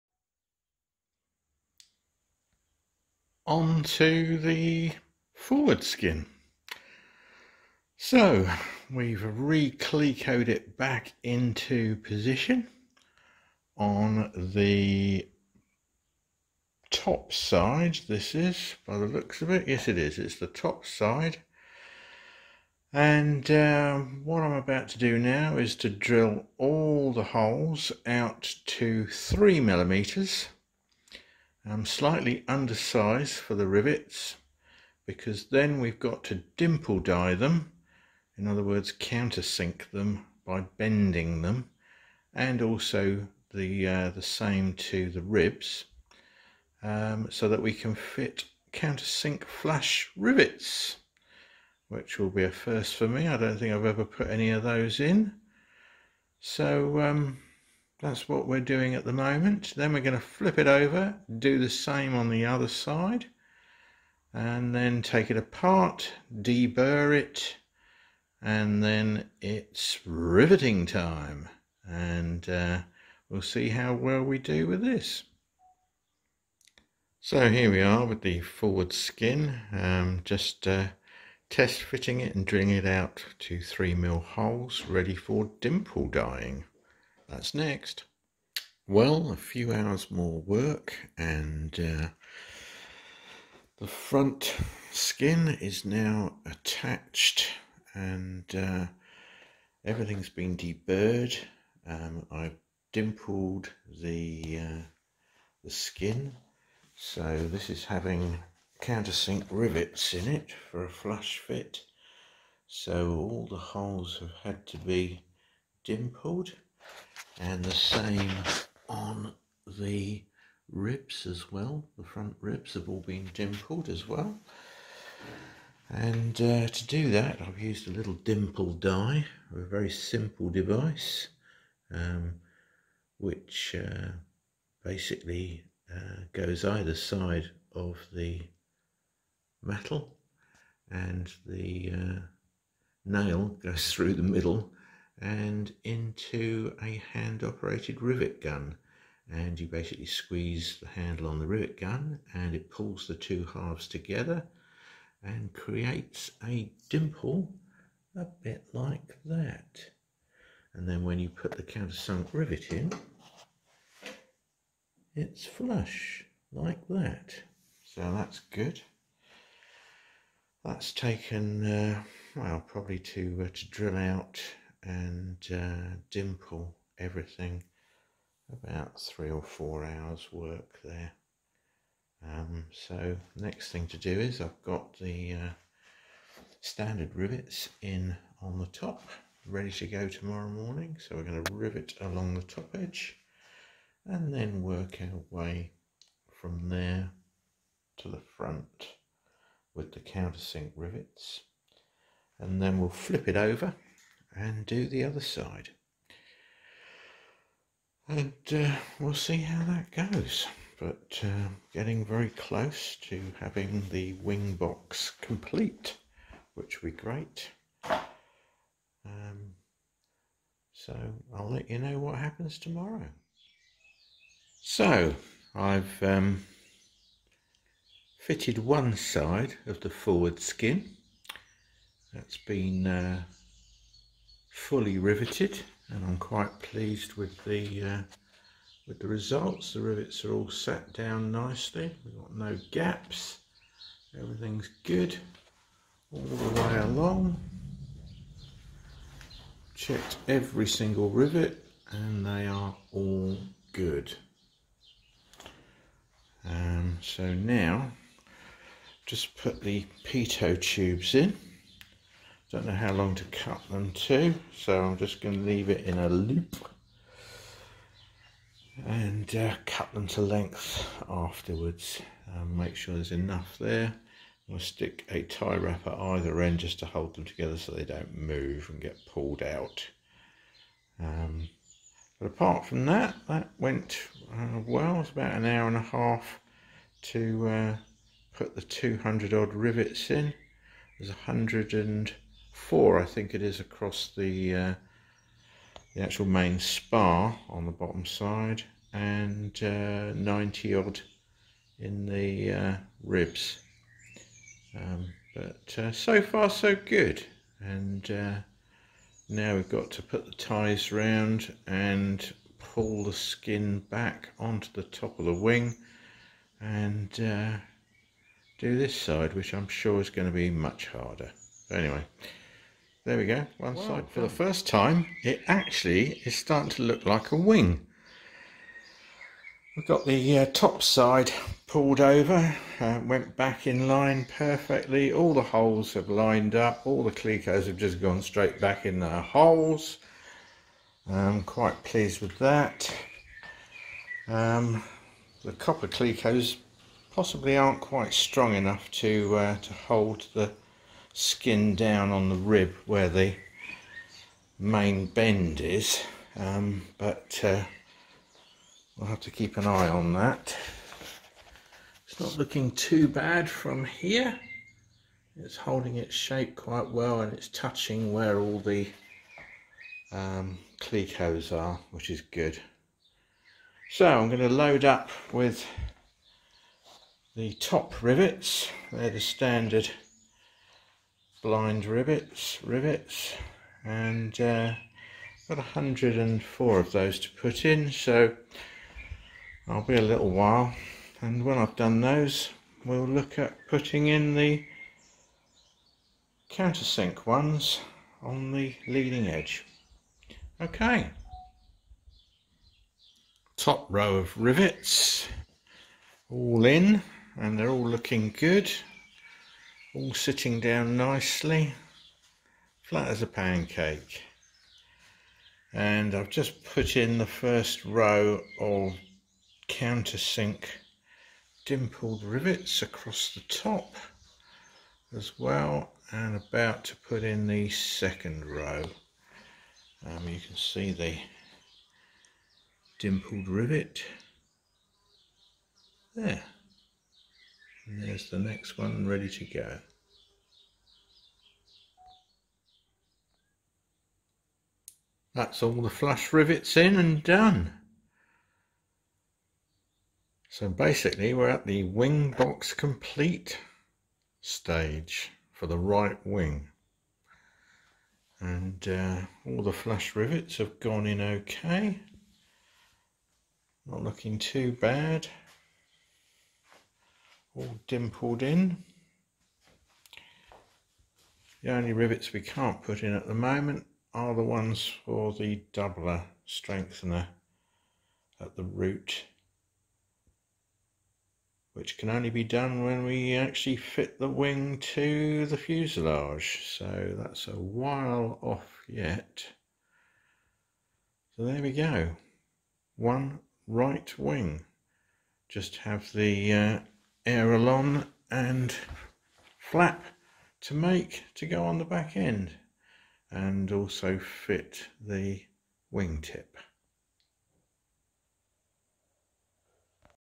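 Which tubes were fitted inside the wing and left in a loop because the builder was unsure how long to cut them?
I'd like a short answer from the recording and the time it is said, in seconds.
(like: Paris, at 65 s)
pitot tubes, at 260 s.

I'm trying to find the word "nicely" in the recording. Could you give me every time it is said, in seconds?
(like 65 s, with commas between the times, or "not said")
241 s, 410 s.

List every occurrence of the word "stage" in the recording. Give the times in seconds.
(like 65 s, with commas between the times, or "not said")
454 s.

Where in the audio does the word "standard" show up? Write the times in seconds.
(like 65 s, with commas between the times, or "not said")
186 s, 379 s.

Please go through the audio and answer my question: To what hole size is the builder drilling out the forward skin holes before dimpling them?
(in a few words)
3 millimeters.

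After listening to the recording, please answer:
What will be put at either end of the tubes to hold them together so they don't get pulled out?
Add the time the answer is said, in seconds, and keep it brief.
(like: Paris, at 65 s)
tie wrap, at 275 s.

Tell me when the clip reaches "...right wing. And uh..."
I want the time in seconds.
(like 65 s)
455 s.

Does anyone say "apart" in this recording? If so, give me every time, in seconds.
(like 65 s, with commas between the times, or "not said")
65 s, 282 s.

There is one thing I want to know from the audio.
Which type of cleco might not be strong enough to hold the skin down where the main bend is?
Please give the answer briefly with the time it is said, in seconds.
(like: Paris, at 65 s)
copper clecos, at 345 s.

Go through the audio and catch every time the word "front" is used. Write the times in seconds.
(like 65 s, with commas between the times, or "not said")
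93 s, 122 s, 198 s.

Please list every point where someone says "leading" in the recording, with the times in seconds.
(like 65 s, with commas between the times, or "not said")
398 s.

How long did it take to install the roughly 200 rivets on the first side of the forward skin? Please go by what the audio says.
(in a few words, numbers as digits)
an hour and a half.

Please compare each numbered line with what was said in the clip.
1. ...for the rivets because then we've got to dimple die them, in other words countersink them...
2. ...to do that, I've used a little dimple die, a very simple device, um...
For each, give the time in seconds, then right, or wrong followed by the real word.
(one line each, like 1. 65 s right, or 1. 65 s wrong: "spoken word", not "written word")
1. 33 s right
2. 126 s right.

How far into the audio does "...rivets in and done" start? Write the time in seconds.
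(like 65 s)
446 s.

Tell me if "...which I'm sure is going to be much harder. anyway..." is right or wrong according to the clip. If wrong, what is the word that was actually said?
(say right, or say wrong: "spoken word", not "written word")
right.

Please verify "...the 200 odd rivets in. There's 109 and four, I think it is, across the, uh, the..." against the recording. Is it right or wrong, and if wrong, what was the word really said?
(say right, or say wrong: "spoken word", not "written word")
wrong: "100", not "109".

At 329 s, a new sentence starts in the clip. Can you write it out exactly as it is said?
We've got the uh, top side pulled over, uh, went back in line perfectly.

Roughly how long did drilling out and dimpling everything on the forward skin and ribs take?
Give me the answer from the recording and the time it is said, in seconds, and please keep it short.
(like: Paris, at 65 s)
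3 or 4 hours, at 178 s.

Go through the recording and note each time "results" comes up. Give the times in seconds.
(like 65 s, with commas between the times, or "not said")
239 s.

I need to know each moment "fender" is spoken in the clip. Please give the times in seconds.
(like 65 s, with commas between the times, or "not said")
not said.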